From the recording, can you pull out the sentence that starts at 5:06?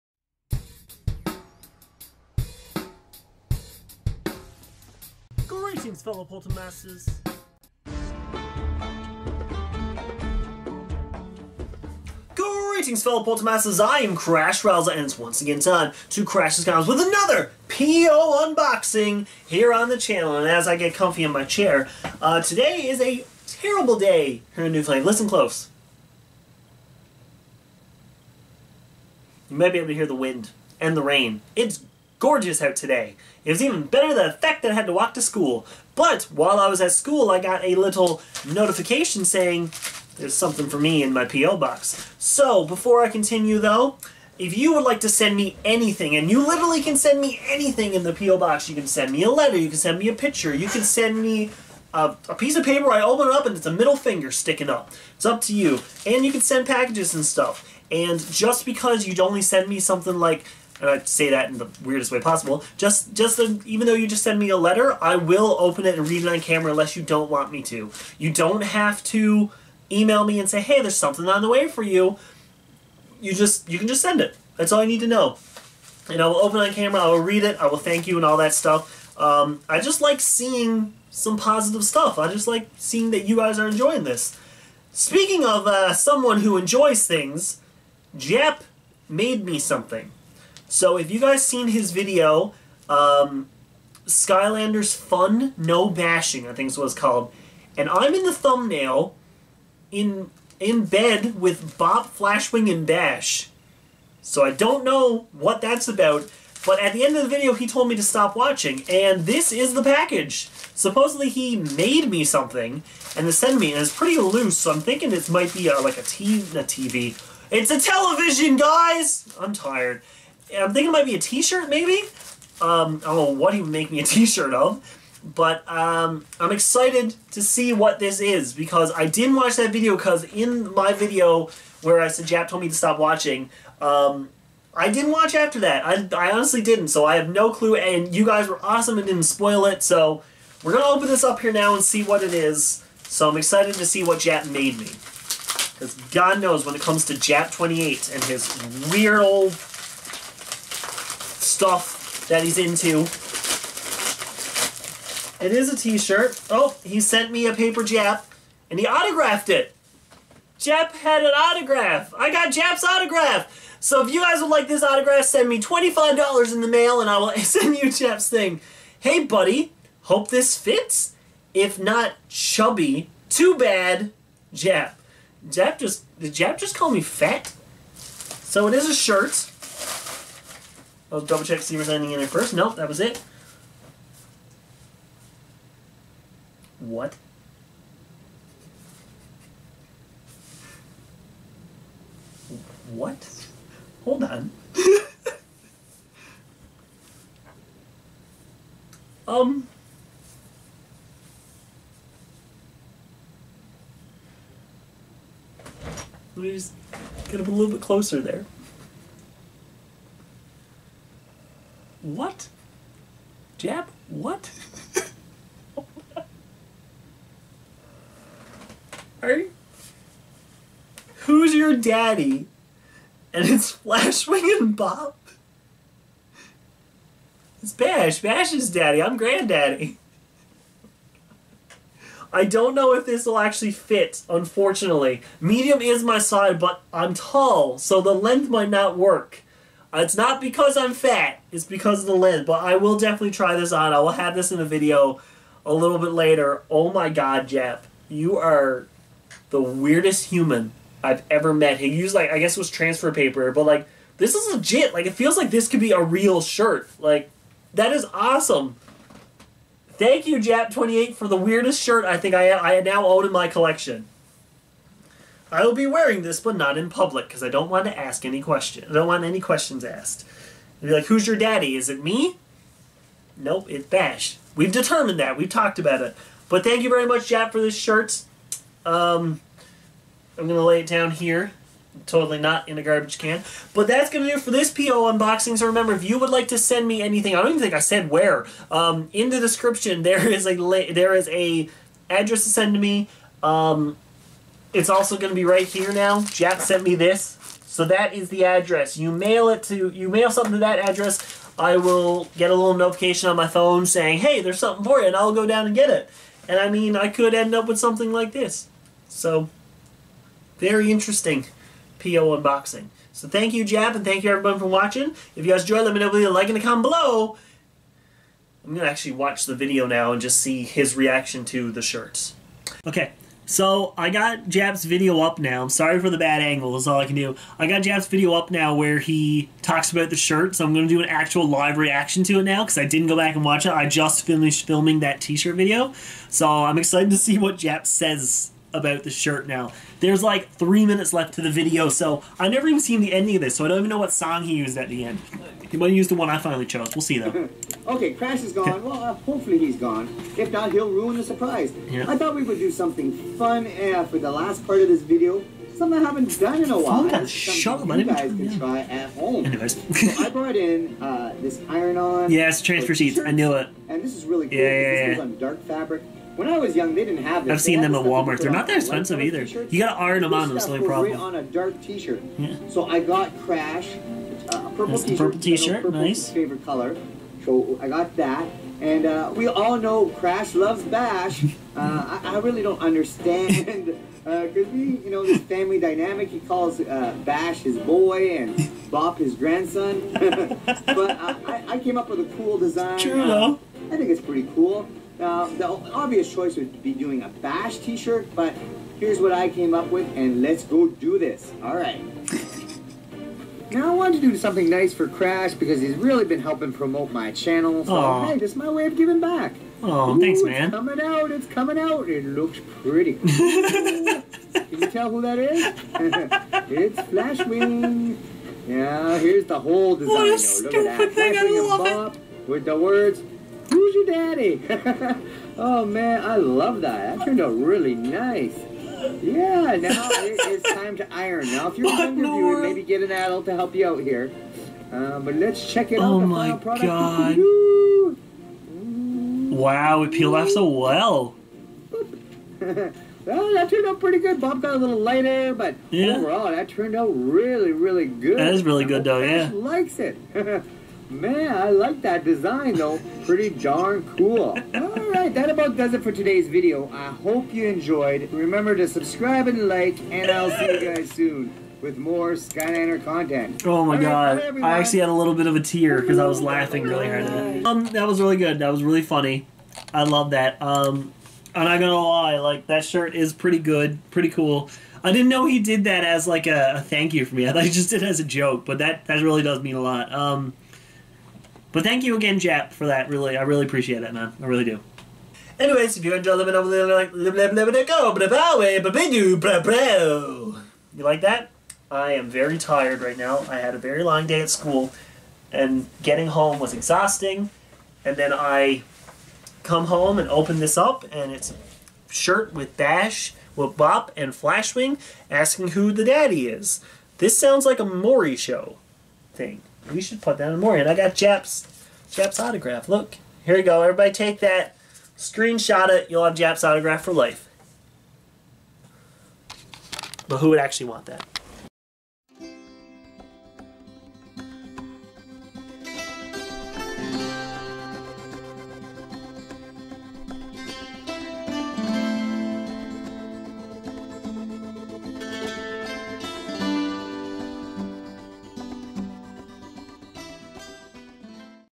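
And I mean, I could end up with something like this.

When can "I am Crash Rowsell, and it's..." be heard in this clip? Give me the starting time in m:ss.
0:13.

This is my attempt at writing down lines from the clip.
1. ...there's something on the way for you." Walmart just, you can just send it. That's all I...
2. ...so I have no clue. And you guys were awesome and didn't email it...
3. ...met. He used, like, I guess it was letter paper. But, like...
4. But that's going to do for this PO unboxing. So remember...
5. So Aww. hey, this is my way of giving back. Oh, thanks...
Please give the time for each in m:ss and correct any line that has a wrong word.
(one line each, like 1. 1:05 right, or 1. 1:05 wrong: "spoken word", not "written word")
1. 1:10 wrong: "You", not "Walmart"
2. 2:16 wrong: "spoil", not "email"
3. 4:11 wrong: "transfer", not "letter"
4. 4:43 right
5. 6:47 right.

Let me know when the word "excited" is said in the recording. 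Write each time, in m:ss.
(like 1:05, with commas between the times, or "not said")
2:06, 2:23, 5:36.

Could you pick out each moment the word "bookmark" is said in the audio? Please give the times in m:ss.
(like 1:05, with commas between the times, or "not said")
not said.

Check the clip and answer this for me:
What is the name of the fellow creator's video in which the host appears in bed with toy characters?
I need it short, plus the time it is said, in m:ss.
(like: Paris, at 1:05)
Skylanders Fun No Bashing, at 1:34.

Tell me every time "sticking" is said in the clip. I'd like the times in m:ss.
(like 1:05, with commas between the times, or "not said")
0:54.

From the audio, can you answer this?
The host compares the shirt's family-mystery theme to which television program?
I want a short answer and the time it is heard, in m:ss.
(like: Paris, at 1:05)
Maury, at 8:27.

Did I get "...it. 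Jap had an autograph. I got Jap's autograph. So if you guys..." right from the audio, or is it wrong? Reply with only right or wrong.
right.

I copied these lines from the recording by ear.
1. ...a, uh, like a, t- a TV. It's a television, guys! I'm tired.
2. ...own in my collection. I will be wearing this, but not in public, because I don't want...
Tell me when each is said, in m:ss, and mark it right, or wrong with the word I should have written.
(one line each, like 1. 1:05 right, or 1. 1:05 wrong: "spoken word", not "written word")
1. 1:55 right
2. 4:23 right.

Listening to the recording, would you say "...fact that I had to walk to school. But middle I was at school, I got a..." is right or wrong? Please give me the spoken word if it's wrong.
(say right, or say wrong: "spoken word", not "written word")
wrong: "while", not "middle".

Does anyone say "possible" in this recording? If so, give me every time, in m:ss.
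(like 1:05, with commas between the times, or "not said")
1:02.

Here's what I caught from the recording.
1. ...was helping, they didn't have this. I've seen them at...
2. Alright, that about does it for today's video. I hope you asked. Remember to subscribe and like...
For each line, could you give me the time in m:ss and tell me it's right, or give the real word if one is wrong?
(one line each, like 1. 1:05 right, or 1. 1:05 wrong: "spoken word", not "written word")
1. 6:06 wrong: "young", not "helping"
2. 7:34 wrong: "enjoyed", not "asked".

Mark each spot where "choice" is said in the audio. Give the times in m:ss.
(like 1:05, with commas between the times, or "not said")
6:36.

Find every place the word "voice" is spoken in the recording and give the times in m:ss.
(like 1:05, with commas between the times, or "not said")
not said.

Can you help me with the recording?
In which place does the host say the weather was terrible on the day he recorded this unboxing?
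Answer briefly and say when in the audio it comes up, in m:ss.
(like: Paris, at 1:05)
Newfoundland, at 0:24.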